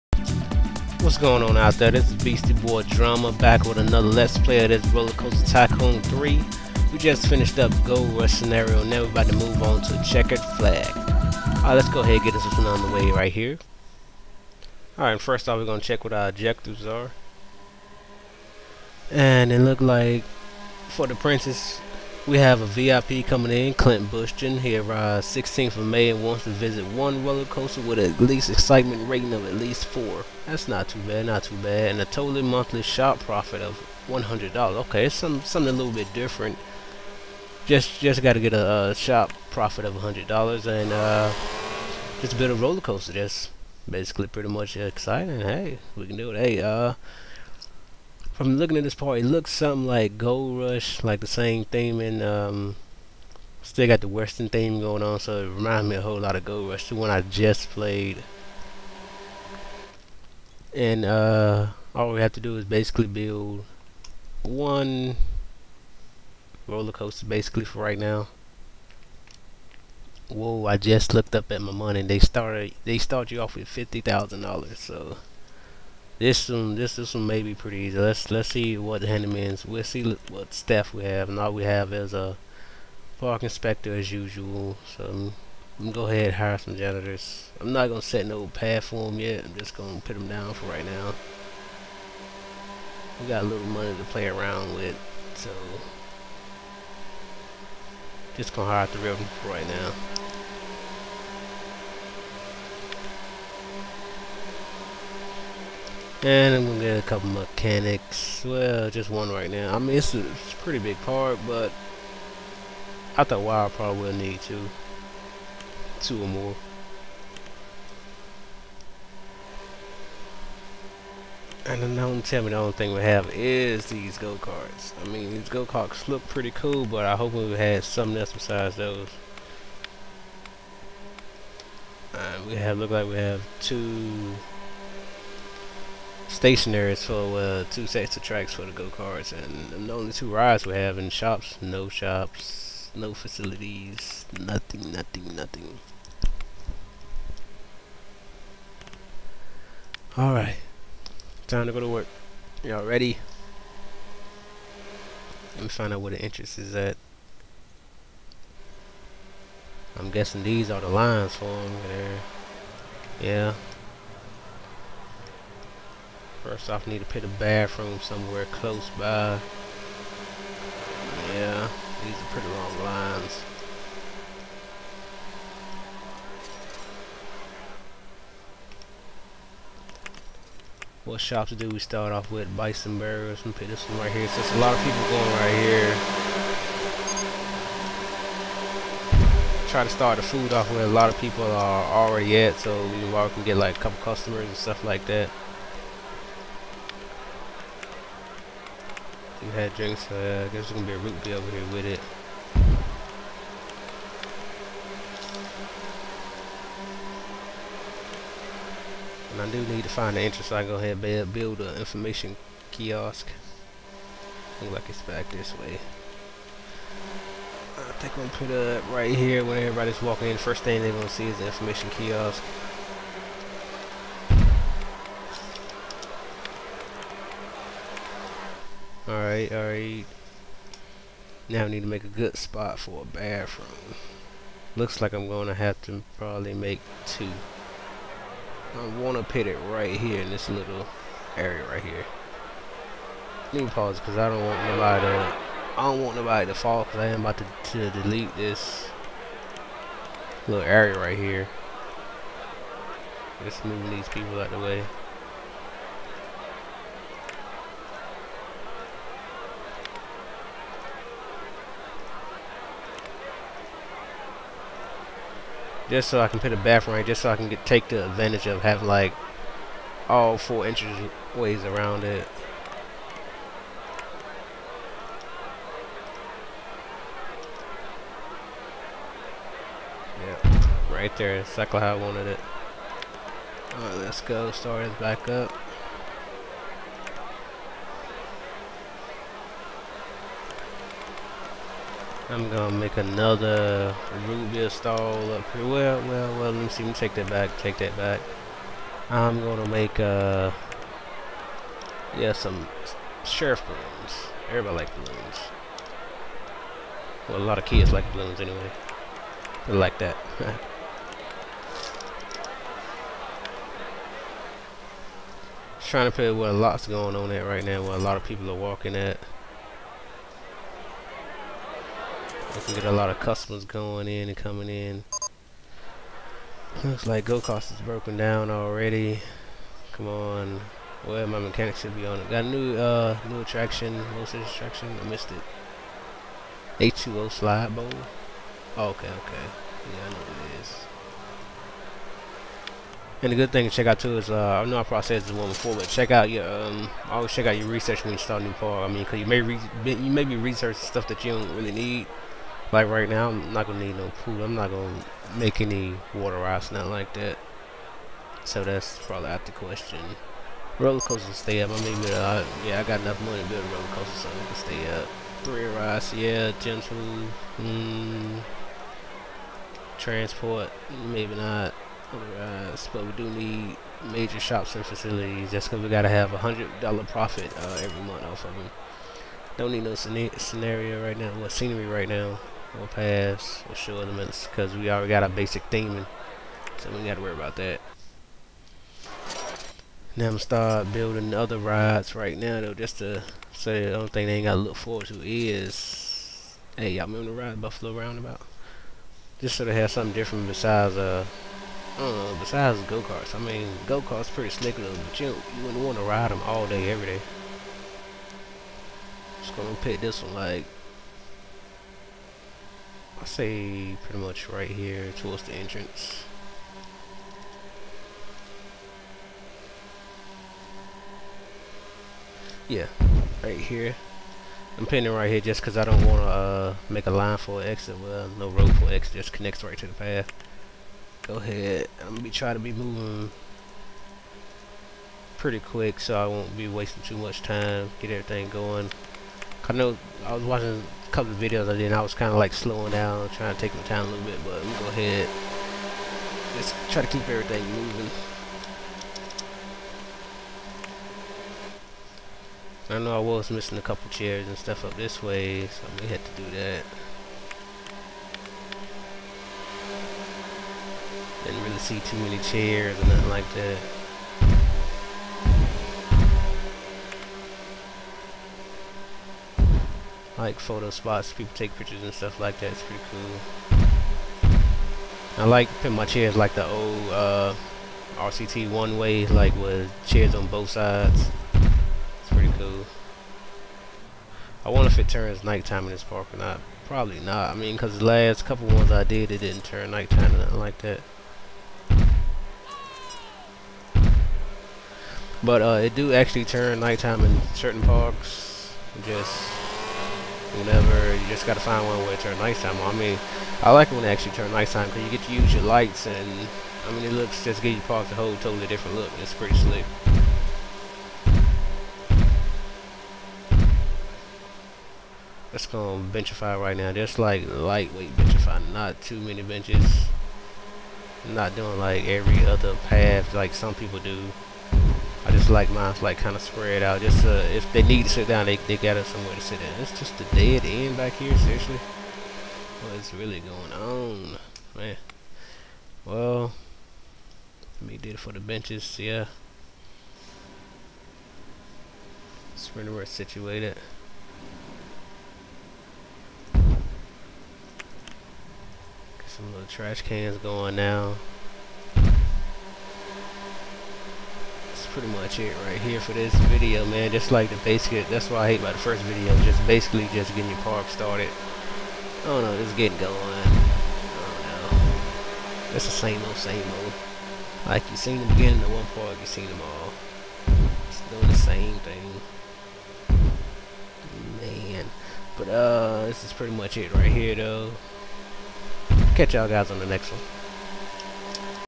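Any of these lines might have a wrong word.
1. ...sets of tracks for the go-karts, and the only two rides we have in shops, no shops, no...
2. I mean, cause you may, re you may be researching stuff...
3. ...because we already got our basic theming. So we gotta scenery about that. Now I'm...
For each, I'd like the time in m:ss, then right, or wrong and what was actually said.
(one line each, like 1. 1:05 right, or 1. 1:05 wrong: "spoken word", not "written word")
1. 2:17 right
2. 5:48 right
3. 6:24 wrong: "worry", not "scenery".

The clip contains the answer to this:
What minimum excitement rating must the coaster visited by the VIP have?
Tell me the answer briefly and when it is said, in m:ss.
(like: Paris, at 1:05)
4, at 0:29.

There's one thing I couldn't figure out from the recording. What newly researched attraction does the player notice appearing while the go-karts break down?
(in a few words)
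H2O slide bowl.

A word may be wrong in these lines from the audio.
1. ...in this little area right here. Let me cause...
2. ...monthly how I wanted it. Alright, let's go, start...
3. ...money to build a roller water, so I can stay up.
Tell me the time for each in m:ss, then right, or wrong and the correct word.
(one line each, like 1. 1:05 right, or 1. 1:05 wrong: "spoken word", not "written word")
1. 4:00 wrong: "pause", not "cause"
2. 4:41 wrong: "exactly", not "monthly"
3. 6:03 wrong: "coaster", not "water".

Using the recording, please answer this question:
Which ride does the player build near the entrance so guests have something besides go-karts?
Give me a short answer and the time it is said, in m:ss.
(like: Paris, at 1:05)
Buffalo Roundabout, at 6:37.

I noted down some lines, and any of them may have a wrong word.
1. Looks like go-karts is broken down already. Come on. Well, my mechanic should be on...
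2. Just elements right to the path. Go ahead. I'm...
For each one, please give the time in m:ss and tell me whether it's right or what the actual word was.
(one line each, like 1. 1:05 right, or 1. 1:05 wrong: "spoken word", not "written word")
1. 5:26 right
2. 7:09 wrong: "connects", not "elements".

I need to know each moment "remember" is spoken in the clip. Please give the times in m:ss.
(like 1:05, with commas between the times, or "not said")
6:37.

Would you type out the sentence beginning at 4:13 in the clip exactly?
Just moving these people out of the way.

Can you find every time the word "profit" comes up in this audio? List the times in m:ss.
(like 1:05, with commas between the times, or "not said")
0:33, 0:39, 6:17.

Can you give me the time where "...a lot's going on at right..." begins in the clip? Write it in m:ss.
5:16.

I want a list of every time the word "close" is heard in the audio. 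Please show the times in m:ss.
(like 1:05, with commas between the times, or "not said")
2:48.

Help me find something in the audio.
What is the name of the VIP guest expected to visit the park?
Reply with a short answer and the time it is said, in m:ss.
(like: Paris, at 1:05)
Clint Bushton, at 0:23.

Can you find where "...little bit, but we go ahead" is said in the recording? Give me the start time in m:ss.
7:24.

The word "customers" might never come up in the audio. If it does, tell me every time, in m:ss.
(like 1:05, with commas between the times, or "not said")
3:14, 5:23.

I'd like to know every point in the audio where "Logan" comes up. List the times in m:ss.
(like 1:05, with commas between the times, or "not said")
not said.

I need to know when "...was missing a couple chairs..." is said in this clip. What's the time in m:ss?
7:33.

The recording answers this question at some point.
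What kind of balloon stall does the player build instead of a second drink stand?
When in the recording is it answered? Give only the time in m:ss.
5:03.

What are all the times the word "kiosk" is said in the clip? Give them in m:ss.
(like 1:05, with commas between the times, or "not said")
3:32, 3:41.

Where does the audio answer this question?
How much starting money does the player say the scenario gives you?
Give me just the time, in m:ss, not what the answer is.
1:13.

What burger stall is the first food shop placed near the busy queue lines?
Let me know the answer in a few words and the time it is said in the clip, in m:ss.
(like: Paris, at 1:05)
Bison Burgers, at 3:02.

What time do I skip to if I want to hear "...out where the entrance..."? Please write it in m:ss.
2:35.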